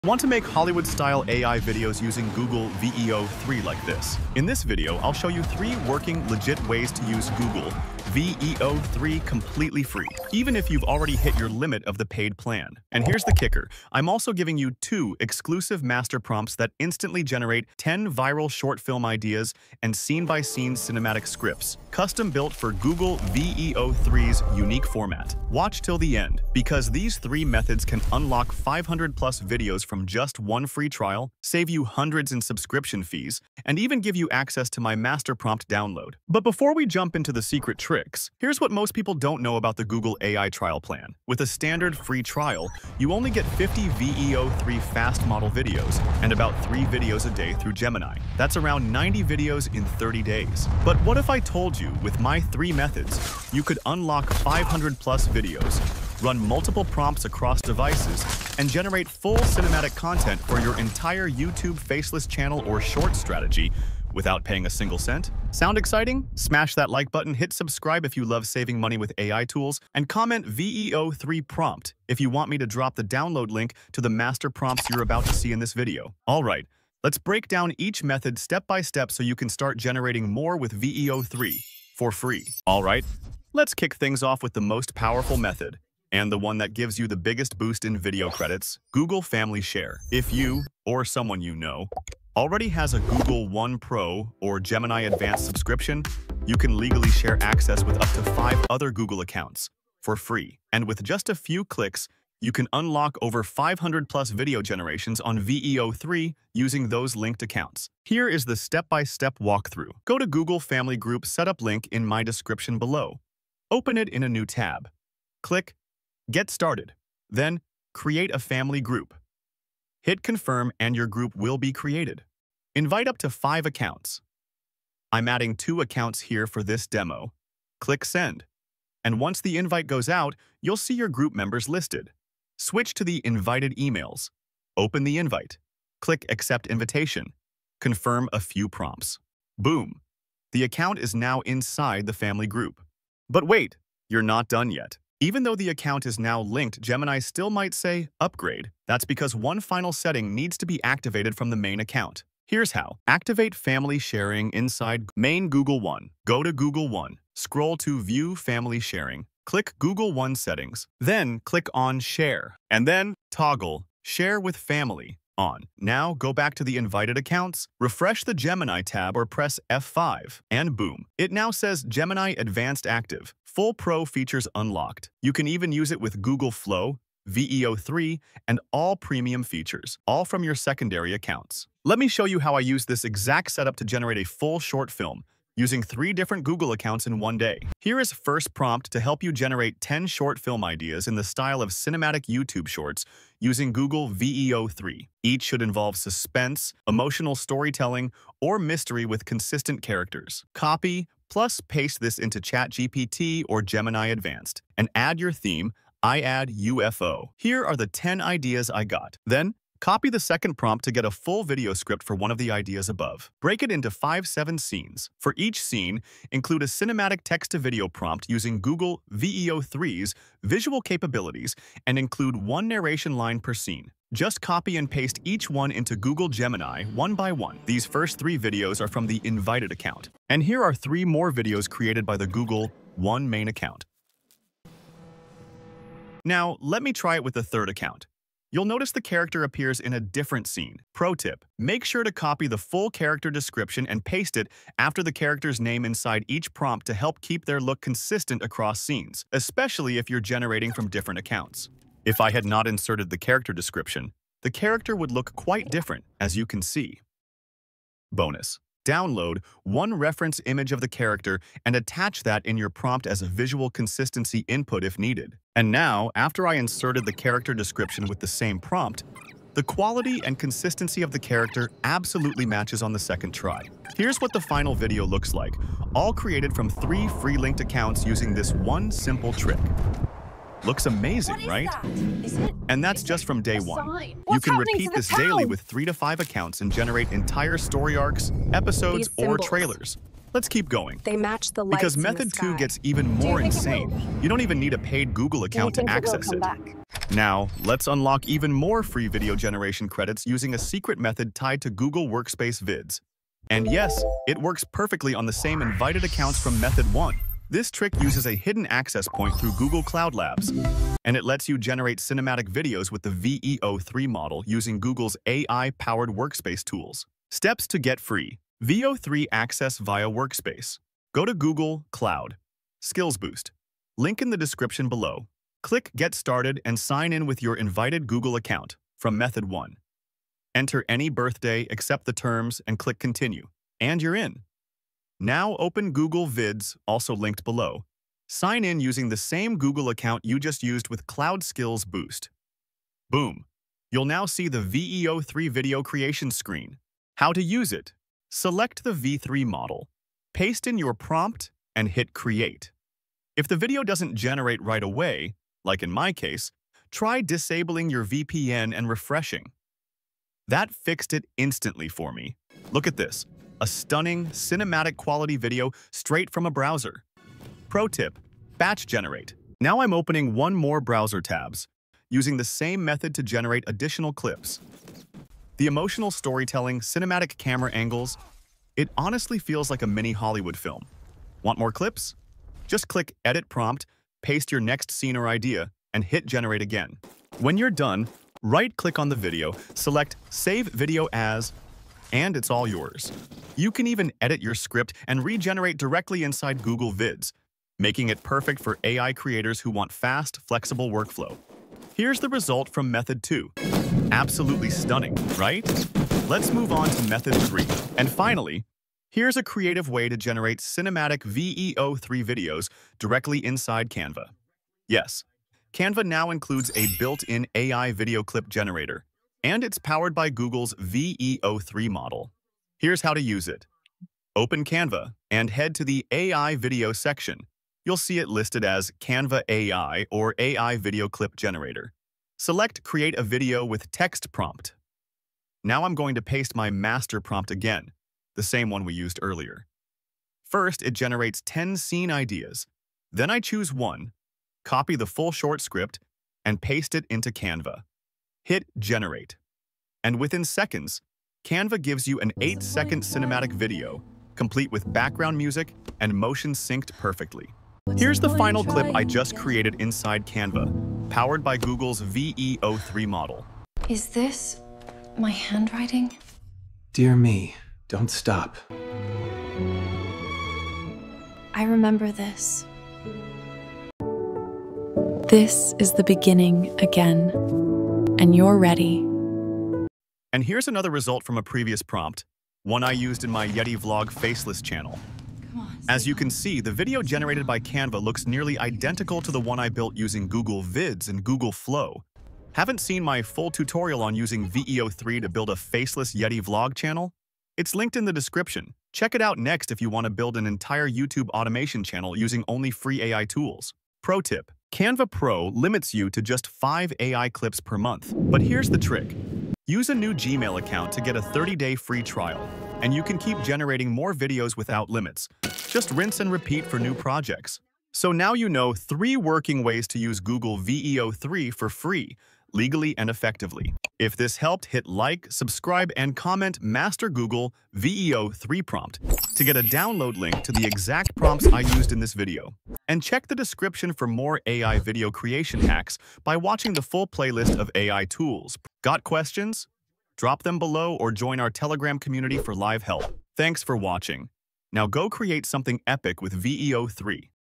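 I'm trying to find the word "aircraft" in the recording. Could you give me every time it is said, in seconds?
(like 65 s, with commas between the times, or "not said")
not said.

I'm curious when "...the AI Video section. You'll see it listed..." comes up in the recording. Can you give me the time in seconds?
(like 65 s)
425 s.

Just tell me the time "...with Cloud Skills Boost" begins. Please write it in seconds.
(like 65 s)
340 s.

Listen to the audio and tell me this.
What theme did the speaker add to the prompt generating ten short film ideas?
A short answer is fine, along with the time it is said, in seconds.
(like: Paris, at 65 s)
UFO, at 206 s.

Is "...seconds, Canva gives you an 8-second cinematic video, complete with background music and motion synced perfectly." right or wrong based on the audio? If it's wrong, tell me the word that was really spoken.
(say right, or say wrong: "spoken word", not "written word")
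right.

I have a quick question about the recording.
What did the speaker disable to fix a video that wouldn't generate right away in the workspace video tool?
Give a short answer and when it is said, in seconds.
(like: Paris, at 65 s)
VPN, at 358 s.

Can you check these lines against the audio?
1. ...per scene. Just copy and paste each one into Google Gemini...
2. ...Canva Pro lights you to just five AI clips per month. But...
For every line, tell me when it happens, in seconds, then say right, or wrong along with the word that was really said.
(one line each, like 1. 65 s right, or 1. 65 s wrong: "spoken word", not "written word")
1. 223 s right
2. 504 s wrong: "limits", not "lights".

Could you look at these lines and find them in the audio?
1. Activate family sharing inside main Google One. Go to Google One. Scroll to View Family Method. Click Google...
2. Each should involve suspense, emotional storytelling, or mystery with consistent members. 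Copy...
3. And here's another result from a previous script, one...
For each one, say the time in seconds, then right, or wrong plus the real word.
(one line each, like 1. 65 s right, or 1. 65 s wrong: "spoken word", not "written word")
1. 153 s wrong: "Sharing", not "Method"
2. 195 s wrong: "characters", not "members"
3. 480 s wrong: "prompt", not "script".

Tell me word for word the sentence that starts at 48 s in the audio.
That's around 90 videos in 30 days.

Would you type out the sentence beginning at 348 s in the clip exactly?
Select the V3 model, paste in your prompt, and hit Create.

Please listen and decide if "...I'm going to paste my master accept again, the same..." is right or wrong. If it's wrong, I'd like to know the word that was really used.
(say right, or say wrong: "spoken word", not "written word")
wrong: "prompt", not "accept".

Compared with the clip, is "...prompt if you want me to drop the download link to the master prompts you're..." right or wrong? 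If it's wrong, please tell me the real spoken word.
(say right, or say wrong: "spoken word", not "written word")
right.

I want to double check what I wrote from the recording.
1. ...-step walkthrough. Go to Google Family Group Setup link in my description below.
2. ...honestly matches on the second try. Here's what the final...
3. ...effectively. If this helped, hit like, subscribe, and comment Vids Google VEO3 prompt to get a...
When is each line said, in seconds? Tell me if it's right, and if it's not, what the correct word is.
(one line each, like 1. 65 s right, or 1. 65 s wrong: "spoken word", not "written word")
1. 109 s right
2. 271 s wrong: "absolutely", not "honestly"
3. 523 s wrong: "Master", not "Vids".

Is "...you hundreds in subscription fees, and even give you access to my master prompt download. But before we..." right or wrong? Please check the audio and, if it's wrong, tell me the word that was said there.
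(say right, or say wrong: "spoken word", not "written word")
right.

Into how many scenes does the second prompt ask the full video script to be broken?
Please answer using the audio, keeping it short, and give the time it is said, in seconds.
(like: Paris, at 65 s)
5-7, at 213 s.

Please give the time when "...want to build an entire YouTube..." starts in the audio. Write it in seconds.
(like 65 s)
499 s.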